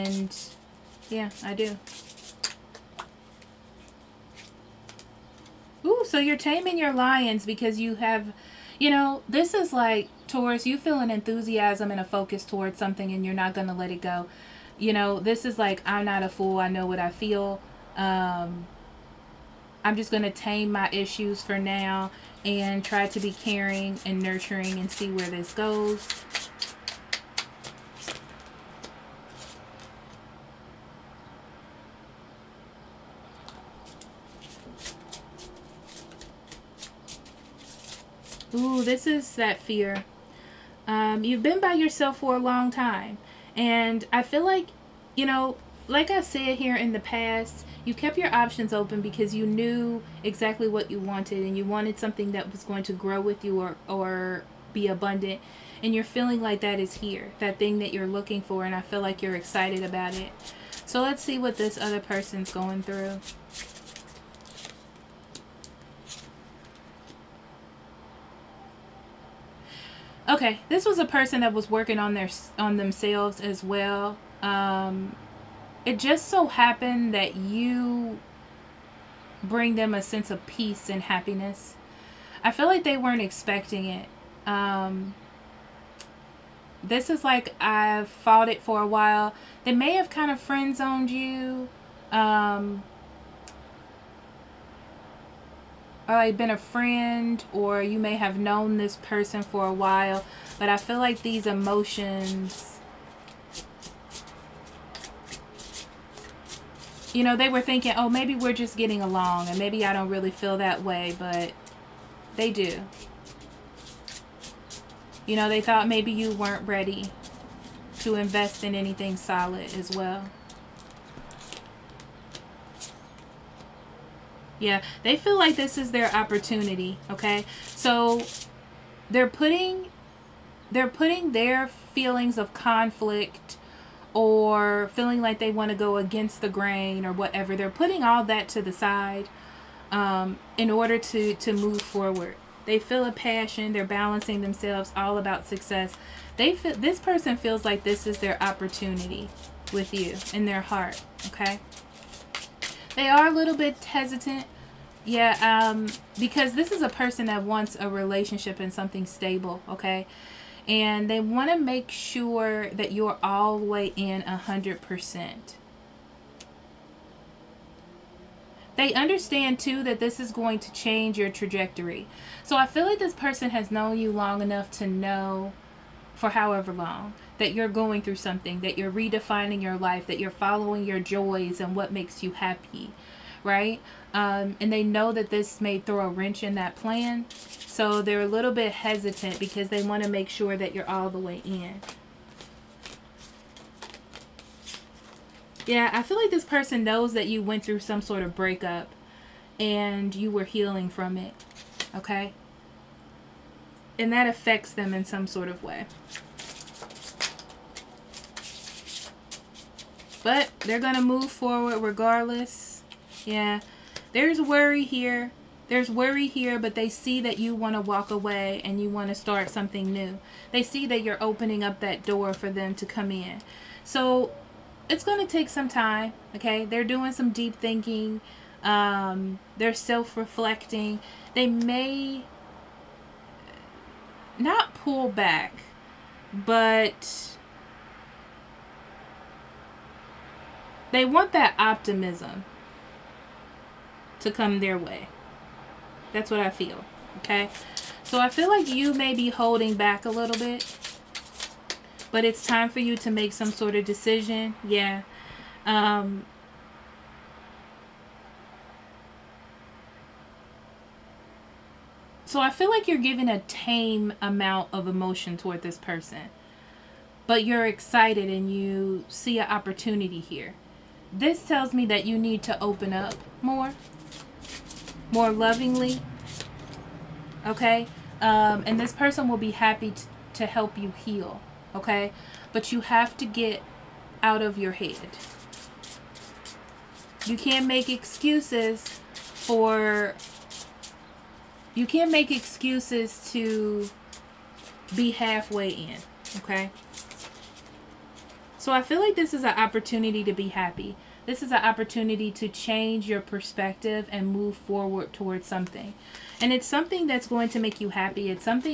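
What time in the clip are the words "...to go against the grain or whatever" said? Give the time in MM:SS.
02:15.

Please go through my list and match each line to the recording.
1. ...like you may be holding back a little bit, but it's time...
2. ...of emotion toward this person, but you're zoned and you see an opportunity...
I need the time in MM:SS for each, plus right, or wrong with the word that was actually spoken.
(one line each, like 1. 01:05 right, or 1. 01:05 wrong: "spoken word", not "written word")
1. 04:08 right
2. 04:24 wrong: "excited", not "zoned".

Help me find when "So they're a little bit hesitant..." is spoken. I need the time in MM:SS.
03:07.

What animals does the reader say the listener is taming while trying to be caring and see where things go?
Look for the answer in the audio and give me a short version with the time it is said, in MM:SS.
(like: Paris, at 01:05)
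lions, at 00:06.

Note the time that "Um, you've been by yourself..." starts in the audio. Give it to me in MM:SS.
00:40.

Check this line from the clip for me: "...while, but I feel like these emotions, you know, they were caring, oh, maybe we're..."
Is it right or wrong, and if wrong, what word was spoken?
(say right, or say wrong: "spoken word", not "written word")
wrong: "thinking", not "caring".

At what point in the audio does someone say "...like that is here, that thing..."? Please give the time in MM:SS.
00:56.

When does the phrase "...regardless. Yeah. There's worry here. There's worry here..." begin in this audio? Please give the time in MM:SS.
03:31.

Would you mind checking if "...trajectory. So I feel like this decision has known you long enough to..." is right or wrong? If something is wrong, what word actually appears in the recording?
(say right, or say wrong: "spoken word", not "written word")
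wrong: "person", not "decision".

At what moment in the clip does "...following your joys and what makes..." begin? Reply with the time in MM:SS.
03:00.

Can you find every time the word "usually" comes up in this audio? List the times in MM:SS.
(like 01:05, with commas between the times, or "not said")
not said.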